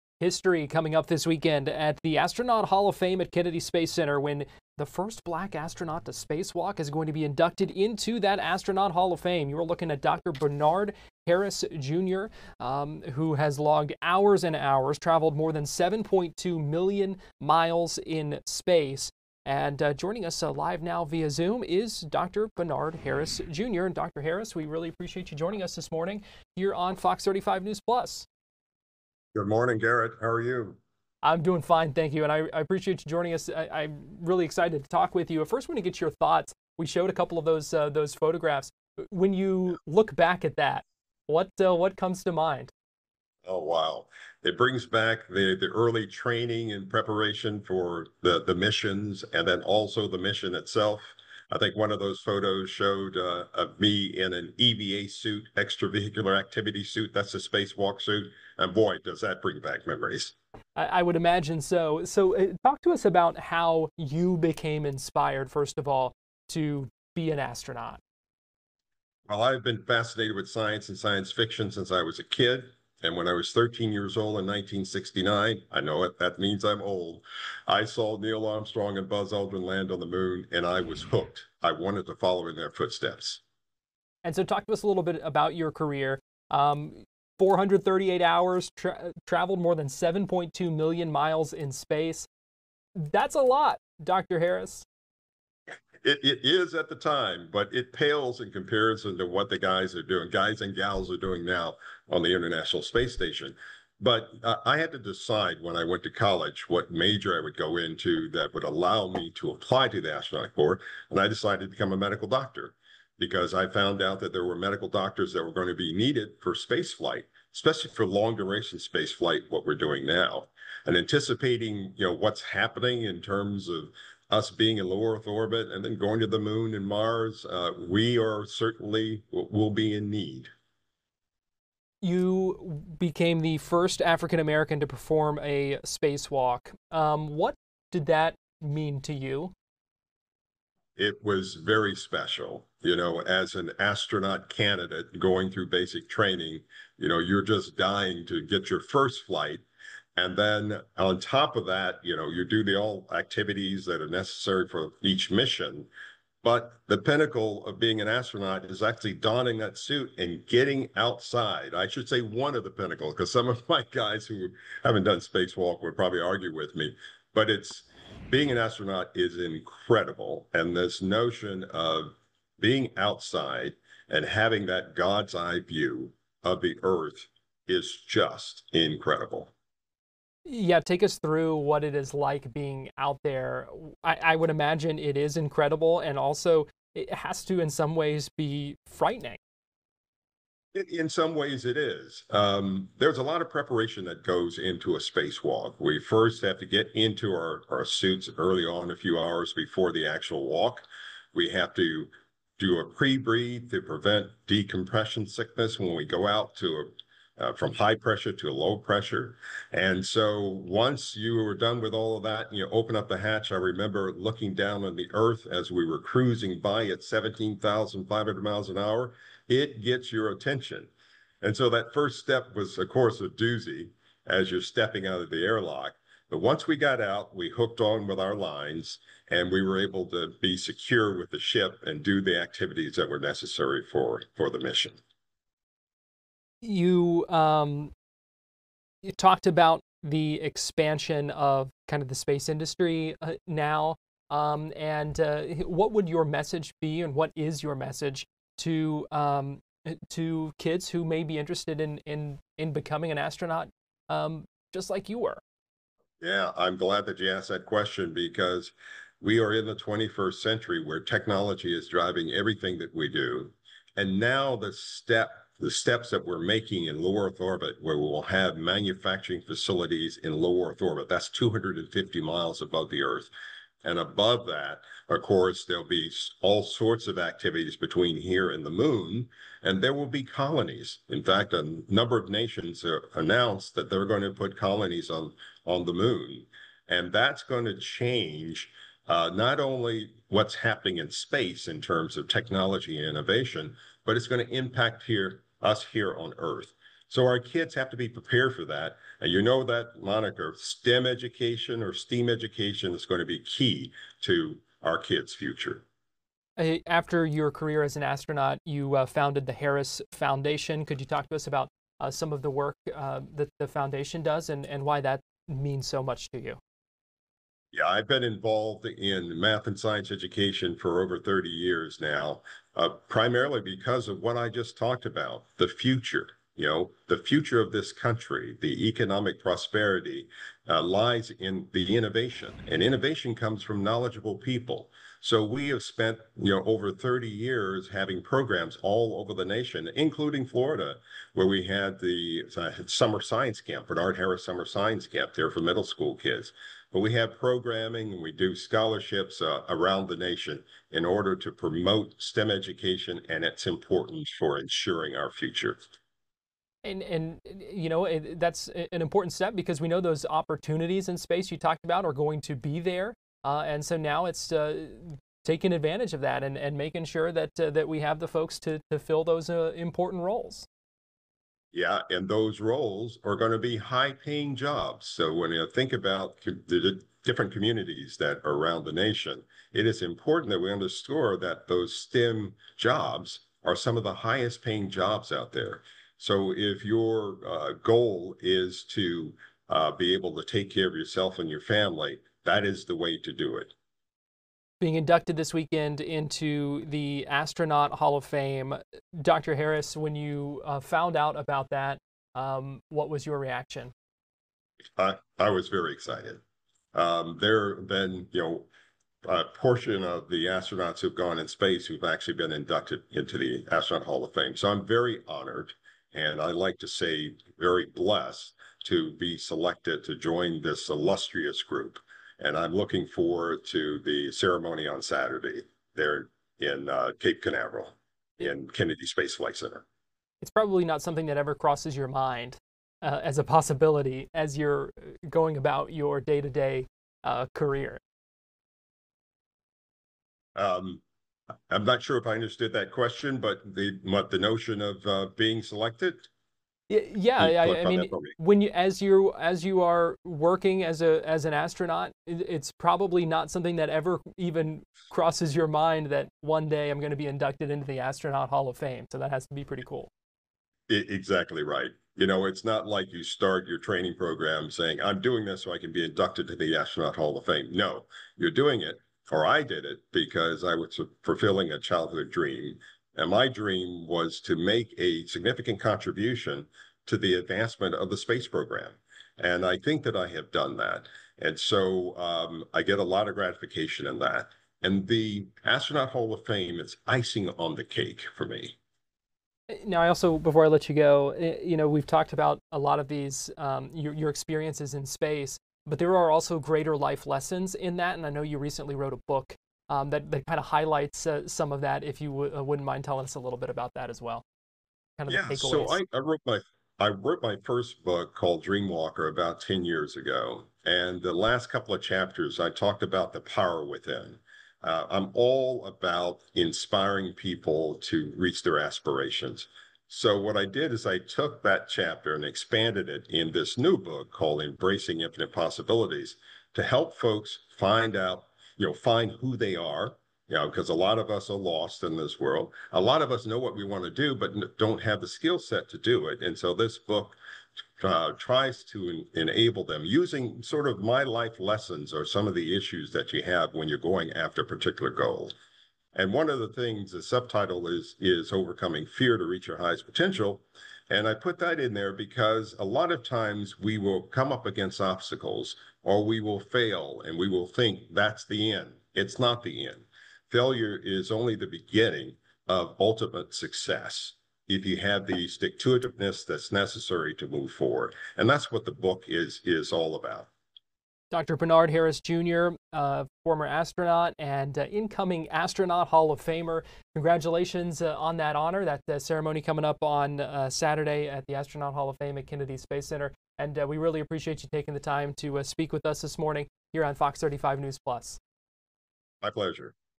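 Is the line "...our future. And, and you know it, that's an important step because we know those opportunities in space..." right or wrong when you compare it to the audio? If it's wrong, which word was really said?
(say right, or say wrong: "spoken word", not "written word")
right.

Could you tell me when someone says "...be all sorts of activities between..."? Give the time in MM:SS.
04:35.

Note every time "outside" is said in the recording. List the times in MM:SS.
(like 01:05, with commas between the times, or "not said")
02:40, 02:52.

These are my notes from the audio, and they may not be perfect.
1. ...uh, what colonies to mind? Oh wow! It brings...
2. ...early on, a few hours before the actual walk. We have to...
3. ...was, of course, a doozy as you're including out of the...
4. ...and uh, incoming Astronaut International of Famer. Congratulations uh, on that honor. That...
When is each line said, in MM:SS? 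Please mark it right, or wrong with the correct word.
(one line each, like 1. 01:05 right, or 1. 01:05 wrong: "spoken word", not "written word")
1. 00:41 wrong: "comes", not "colonies"
2. 03:18 right
3. 03:42 wrong: "stepping", not "including"
4. 09:34 wrong: "Hall", not "International".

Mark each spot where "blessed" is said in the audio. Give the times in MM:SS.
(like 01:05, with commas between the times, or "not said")
06:57.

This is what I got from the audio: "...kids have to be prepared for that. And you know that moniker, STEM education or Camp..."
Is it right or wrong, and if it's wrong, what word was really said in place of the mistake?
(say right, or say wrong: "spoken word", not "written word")
wrong: "STEAM", not "Camp".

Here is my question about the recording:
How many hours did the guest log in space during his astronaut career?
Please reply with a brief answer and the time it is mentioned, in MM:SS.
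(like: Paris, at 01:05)
438, at 01:27.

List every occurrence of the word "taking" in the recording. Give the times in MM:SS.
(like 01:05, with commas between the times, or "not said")
06:05, 09:44.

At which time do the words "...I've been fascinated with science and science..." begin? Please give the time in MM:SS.
01:09.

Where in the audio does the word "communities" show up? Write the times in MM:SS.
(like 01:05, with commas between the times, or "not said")
06:17.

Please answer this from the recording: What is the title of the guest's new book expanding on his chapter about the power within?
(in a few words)
Embracing Infinite Possibilities.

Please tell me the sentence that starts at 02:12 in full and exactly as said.
You became the first African American to perform a spacewalk.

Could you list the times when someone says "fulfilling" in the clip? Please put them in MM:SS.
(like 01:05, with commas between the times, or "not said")
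07:51.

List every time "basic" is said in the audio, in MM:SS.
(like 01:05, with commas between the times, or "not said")
02:25.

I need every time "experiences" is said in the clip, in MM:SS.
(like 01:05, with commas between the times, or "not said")
08:14.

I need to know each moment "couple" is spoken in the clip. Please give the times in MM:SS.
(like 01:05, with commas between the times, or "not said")
00:37, 08:31.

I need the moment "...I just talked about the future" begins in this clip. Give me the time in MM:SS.
05:24.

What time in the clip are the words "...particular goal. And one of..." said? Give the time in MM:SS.
09:04.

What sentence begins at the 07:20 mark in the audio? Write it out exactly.
Um, I'm not sure if I understood that question, but the, the notion of uh, being selected?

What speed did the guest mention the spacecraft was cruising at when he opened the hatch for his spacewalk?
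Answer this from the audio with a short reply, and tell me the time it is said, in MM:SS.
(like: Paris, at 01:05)
17,500 miles an hour, at 03:37.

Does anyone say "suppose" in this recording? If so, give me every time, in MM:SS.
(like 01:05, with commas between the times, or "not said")
not said.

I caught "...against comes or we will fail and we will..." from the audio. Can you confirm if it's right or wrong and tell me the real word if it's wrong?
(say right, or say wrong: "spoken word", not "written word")
wrong: "obstacles", not "comes".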